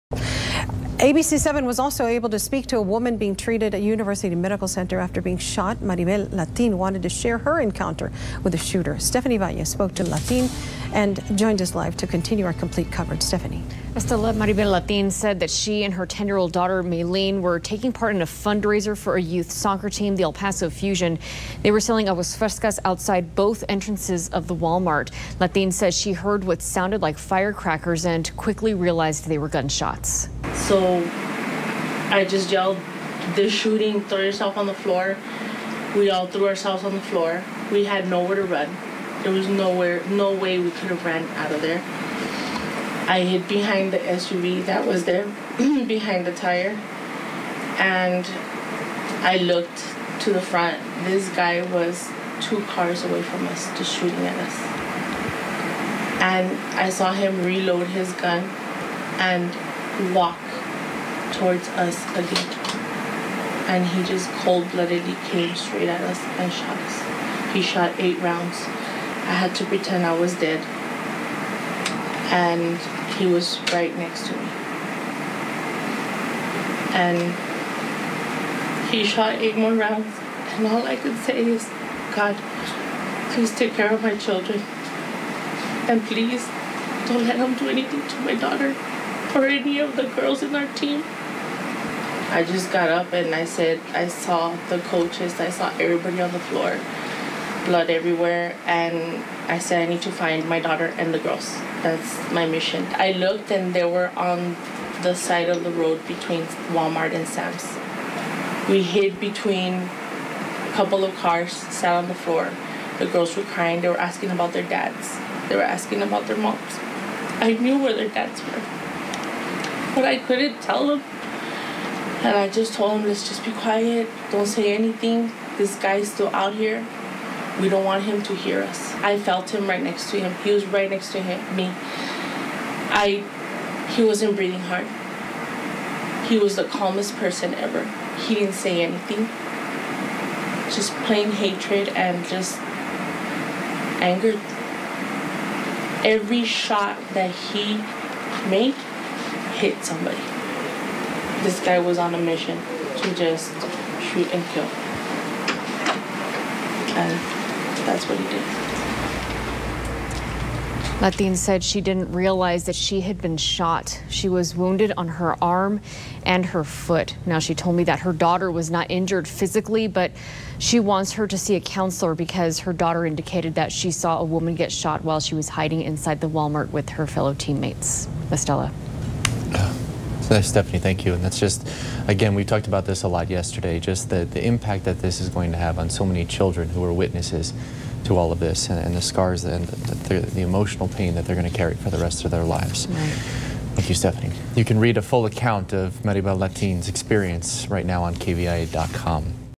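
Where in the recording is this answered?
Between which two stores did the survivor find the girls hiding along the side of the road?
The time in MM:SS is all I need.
01:46.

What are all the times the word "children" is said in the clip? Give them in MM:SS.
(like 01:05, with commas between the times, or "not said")
01:24, 03:06.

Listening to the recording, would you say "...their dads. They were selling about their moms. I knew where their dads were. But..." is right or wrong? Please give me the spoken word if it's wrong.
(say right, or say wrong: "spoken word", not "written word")
wrong: "asking", not "selling".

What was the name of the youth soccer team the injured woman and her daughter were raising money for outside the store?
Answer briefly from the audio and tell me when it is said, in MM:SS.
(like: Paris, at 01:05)
El Paso Fusion, at 00:20.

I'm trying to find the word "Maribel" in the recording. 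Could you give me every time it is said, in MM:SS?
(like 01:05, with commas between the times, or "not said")
00:05, 00:14, 03:16.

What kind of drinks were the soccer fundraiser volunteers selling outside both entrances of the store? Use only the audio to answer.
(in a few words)
aguas frescas.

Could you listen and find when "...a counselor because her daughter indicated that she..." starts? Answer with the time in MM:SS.
02:51.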